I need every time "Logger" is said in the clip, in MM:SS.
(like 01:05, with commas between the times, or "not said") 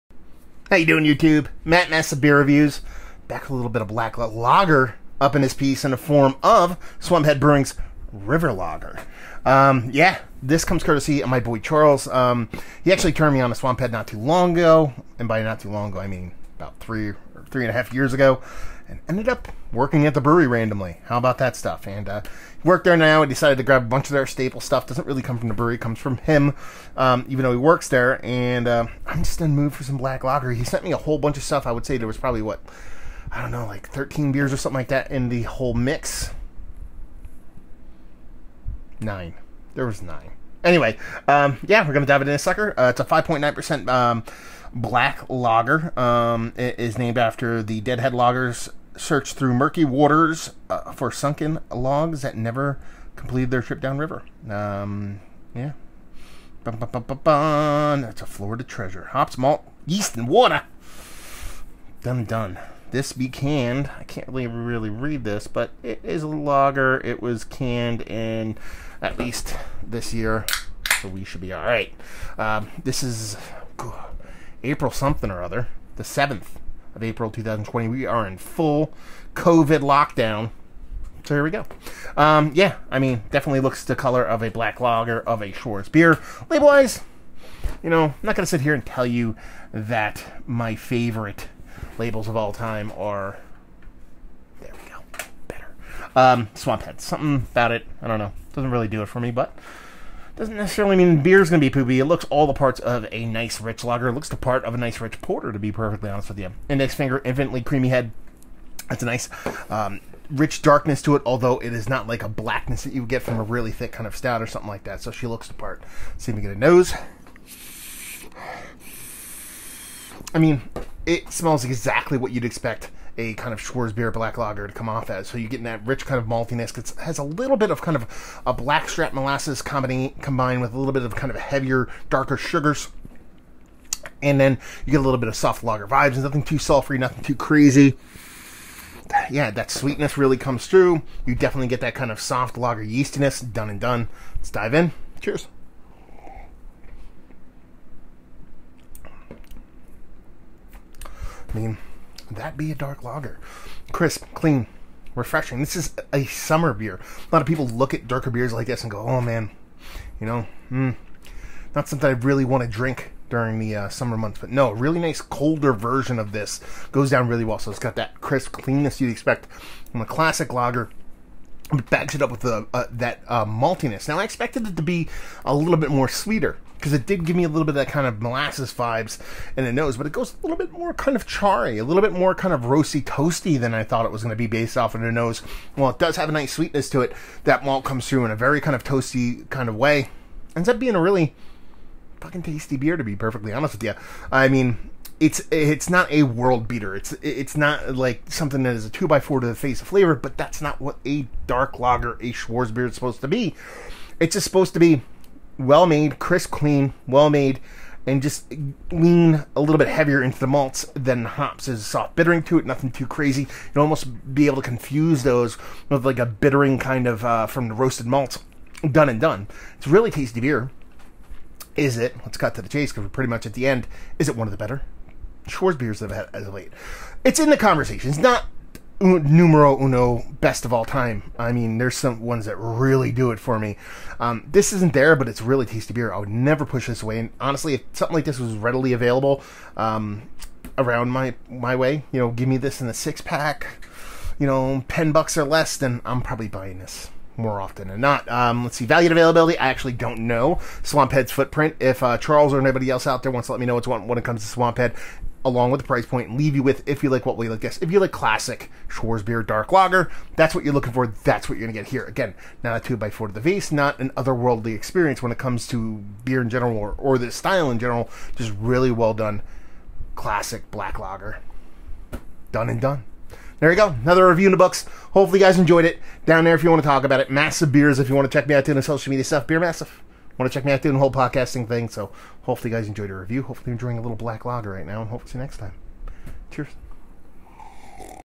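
00:08, 00:48.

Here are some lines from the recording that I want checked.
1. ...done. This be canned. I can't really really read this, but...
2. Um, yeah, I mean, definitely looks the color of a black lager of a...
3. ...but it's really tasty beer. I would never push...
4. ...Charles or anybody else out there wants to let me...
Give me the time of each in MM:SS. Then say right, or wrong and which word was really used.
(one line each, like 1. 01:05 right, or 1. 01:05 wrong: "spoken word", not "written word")
1. 01:02 right
2. 01:22 right
3. 03:55 right
4. 04:12 right.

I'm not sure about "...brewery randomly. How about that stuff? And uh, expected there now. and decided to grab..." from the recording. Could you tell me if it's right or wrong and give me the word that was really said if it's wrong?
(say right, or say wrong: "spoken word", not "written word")
wrong: "worked", not "expected".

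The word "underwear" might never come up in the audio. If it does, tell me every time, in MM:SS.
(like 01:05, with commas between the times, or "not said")
not said.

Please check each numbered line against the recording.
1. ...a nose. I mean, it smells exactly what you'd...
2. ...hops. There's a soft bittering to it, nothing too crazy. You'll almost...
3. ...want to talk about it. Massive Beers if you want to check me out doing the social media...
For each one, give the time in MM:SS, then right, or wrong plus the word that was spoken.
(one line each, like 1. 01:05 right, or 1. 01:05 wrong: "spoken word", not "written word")
1. 01:56 right
2. 03:31 right
3. 04:36 right.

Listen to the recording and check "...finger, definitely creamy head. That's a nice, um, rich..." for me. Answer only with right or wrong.
wrong.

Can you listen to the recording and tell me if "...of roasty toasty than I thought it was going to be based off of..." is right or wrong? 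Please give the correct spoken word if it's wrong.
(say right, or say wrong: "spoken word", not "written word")
right.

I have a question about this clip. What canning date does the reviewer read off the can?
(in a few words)
April 7, 2020.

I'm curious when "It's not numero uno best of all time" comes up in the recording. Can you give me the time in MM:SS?
03:48.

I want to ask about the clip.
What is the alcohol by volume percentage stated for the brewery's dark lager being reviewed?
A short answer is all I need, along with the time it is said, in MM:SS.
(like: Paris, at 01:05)
5.9%, at 00:43.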